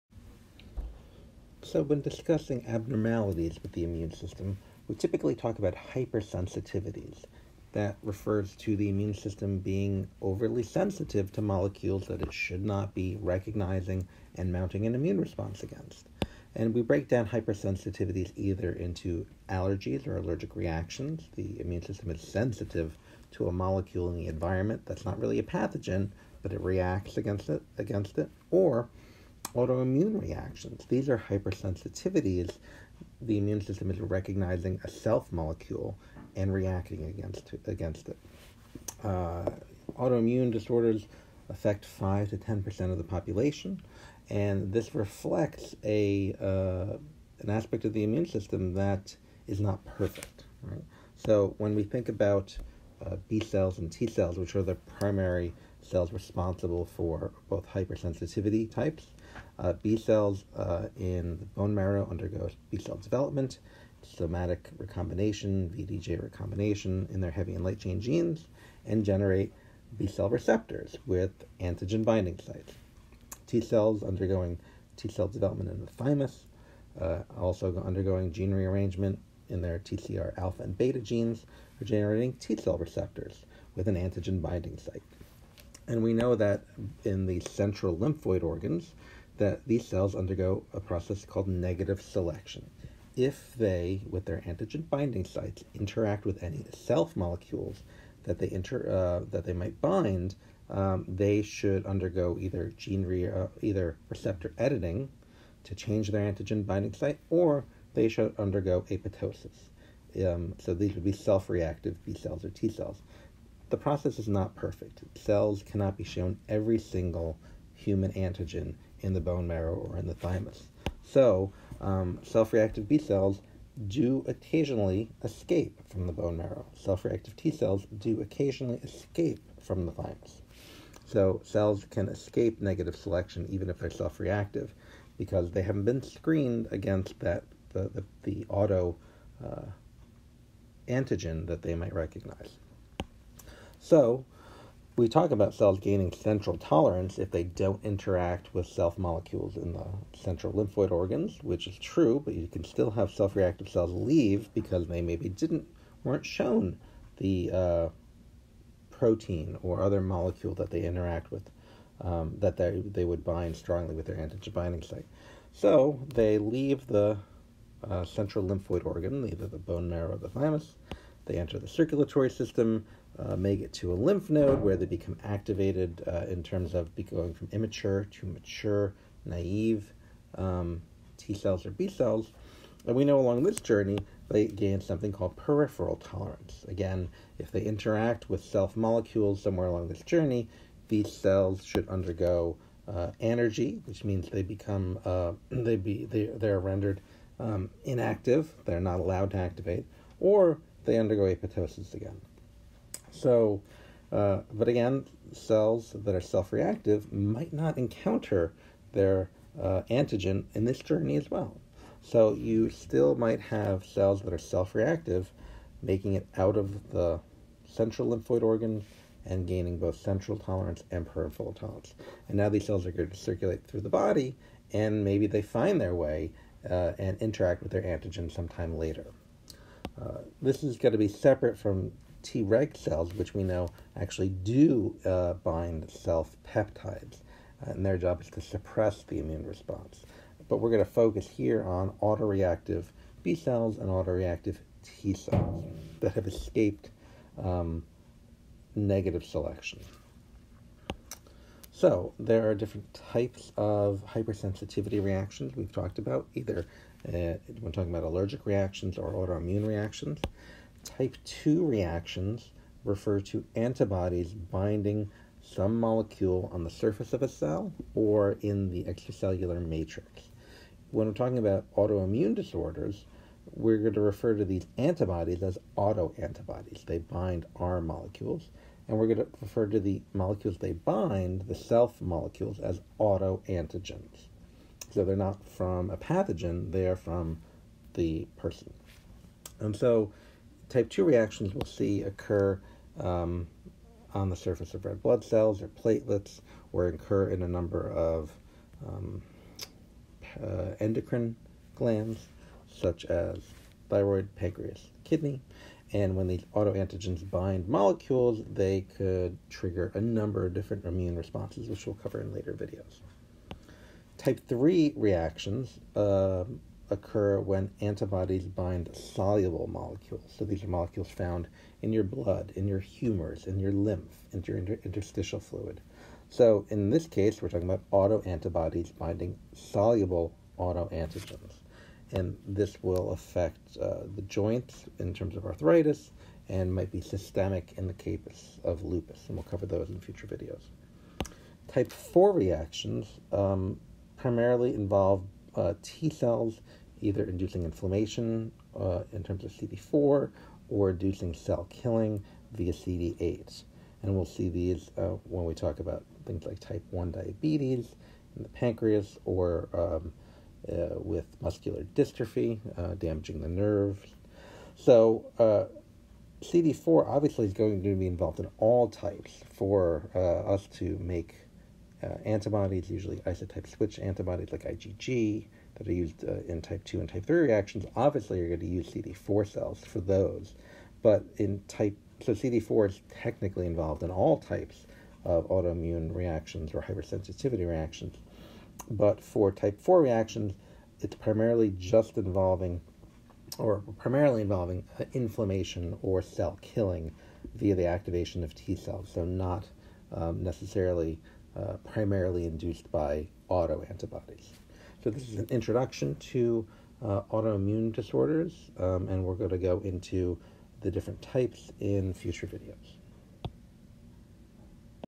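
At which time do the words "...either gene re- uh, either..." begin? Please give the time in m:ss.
1:42.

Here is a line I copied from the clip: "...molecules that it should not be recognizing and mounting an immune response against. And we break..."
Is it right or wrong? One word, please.
right.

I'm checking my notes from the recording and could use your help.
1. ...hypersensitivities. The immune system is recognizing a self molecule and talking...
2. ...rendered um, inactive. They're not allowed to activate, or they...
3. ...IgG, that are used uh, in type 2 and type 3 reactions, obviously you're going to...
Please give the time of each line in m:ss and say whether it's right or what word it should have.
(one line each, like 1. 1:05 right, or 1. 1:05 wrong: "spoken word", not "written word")
1. 0:31 wrong: "reacting", not "talking"
2. 3:16 right
3. 6:14 right.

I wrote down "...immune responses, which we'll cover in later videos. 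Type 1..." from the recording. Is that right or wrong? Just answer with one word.
wrong.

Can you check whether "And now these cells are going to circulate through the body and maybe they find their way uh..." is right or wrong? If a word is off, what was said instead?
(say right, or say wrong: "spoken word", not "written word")
right.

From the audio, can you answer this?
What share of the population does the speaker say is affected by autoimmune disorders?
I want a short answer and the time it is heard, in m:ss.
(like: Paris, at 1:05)
5 to 10 percent, at 0:41.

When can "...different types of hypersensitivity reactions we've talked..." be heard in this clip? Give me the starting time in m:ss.
4:12.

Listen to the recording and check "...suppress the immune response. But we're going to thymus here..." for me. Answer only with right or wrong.
wrong.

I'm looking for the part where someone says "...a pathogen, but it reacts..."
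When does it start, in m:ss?
0:25.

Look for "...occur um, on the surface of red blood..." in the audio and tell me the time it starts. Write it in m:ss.
4:52.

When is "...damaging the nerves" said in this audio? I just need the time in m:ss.
6:02.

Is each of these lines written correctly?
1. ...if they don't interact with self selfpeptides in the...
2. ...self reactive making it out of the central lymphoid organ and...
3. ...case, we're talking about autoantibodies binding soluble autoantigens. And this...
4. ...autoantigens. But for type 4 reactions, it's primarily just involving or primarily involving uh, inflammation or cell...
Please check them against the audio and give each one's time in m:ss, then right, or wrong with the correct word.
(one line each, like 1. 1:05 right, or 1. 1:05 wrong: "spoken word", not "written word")
1. 2:27 wrong: "molecules", not "selfpeptides"
2. 3:34 right
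3. 5:27 right
4. 6:27 wrong: "reactions", not "autoantigens".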